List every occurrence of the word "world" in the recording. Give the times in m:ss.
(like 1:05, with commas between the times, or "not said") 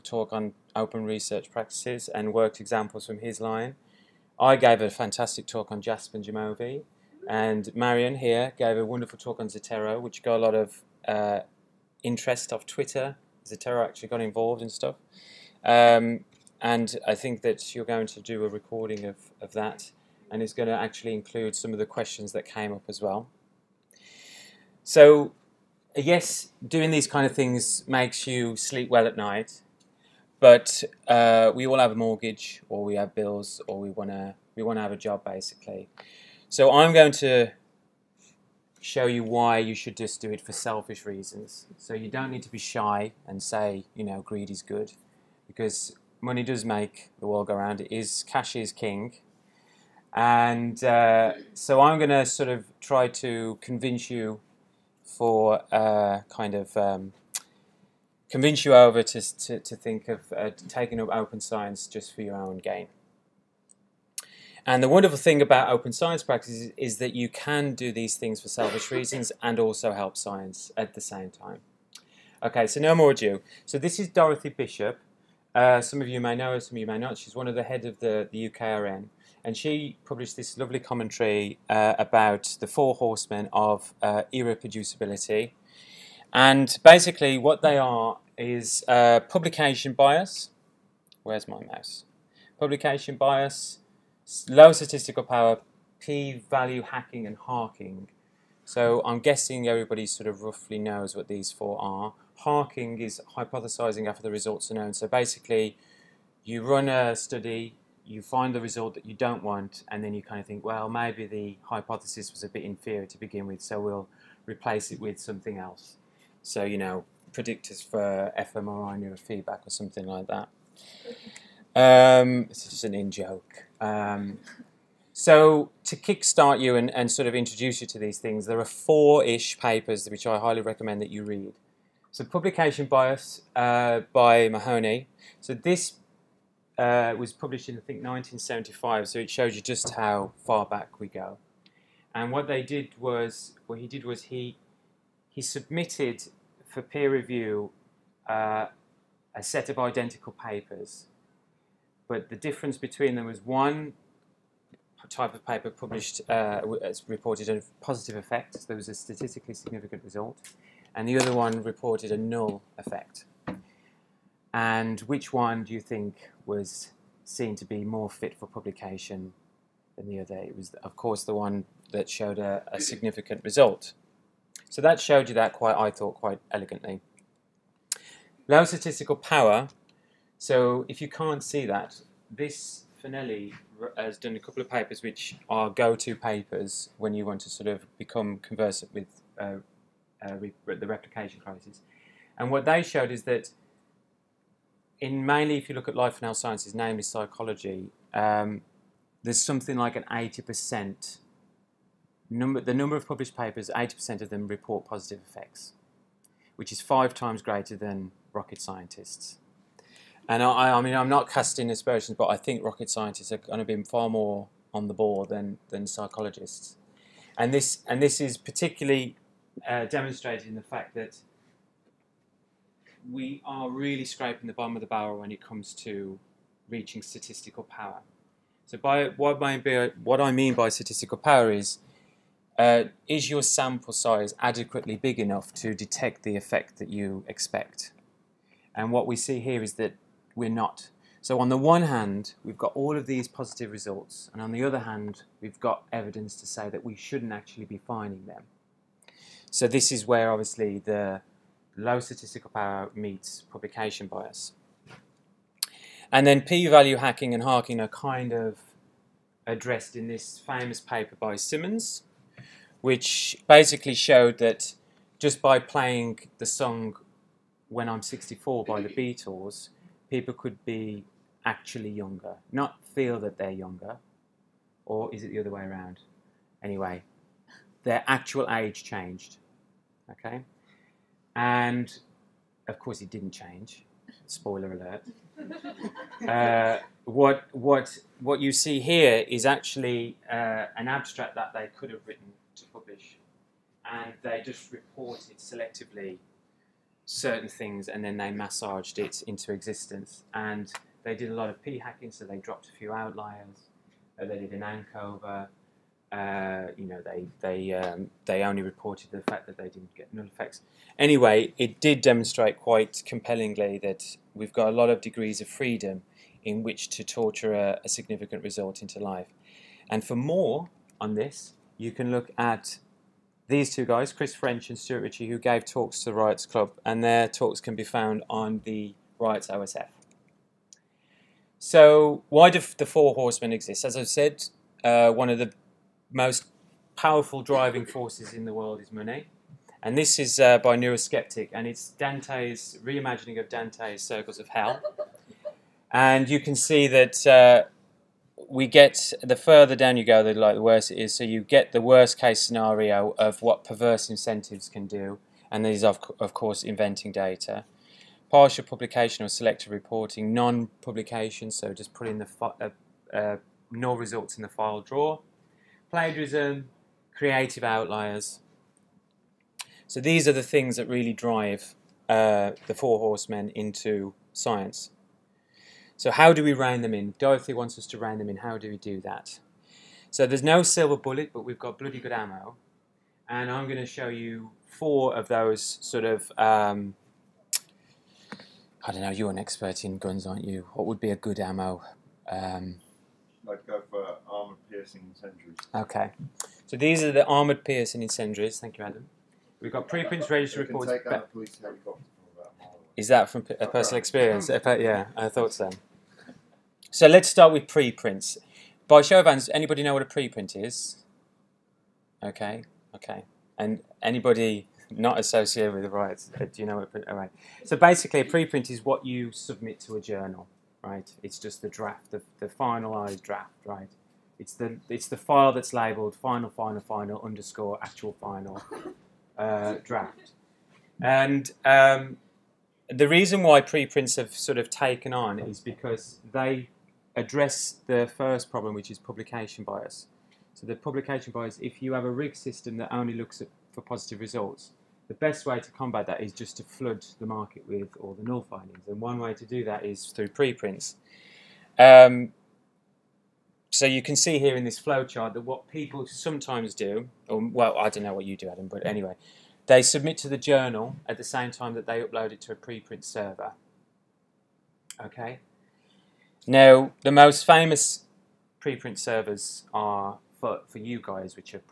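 0:47, 5:38.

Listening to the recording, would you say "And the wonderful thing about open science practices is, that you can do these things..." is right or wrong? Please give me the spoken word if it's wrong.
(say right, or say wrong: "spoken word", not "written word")
right.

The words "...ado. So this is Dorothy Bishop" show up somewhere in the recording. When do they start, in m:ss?
1:13.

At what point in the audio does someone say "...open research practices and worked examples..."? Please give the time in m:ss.
0:00.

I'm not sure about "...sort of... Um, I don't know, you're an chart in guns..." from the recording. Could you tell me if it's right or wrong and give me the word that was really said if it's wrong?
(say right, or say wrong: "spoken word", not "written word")
wrong: "expert", not "chart".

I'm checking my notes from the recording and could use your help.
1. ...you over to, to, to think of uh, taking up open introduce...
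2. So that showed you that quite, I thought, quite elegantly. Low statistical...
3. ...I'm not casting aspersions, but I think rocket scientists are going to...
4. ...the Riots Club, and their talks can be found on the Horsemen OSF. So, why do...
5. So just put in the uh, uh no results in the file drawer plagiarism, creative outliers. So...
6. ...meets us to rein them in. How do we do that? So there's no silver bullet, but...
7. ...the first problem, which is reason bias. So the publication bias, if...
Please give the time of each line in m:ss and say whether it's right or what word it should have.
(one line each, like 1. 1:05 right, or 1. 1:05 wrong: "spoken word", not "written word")
1. 0:58 wrong: "science", not "introduce"
2. 2:54 right
3. 3:30 right
4. 5:26 wrong: "Riots", not "Horsemen"
5. 6:01 right
6. 6:17 wrong: "wants", not "meets"
7. 7:17 wrong: "publication", not "reason".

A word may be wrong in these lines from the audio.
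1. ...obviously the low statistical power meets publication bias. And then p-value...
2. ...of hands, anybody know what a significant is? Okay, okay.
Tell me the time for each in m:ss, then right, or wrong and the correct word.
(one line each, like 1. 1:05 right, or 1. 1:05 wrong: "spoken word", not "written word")
1. 4:10 right
2. 6:49 wrong: "preprint", not "significant".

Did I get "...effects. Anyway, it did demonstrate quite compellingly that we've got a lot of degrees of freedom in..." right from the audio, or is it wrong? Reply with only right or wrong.
right.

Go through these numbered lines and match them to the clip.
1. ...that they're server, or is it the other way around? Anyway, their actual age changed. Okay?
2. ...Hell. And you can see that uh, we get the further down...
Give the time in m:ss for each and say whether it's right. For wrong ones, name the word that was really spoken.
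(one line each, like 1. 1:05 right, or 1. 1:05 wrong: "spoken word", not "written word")
1. 4:33 wrong: "younger", not "server"
2. 5:44 right.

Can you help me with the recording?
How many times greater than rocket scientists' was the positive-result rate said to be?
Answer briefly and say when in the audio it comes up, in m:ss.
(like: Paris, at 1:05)
5, at 3:26.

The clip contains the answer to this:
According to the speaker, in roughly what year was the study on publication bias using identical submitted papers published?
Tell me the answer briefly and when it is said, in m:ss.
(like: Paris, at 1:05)
1975, at 2:18.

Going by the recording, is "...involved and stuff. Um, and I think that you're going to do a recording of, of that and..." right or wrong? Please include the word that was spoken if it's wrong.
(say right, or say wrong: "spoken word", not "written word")
right.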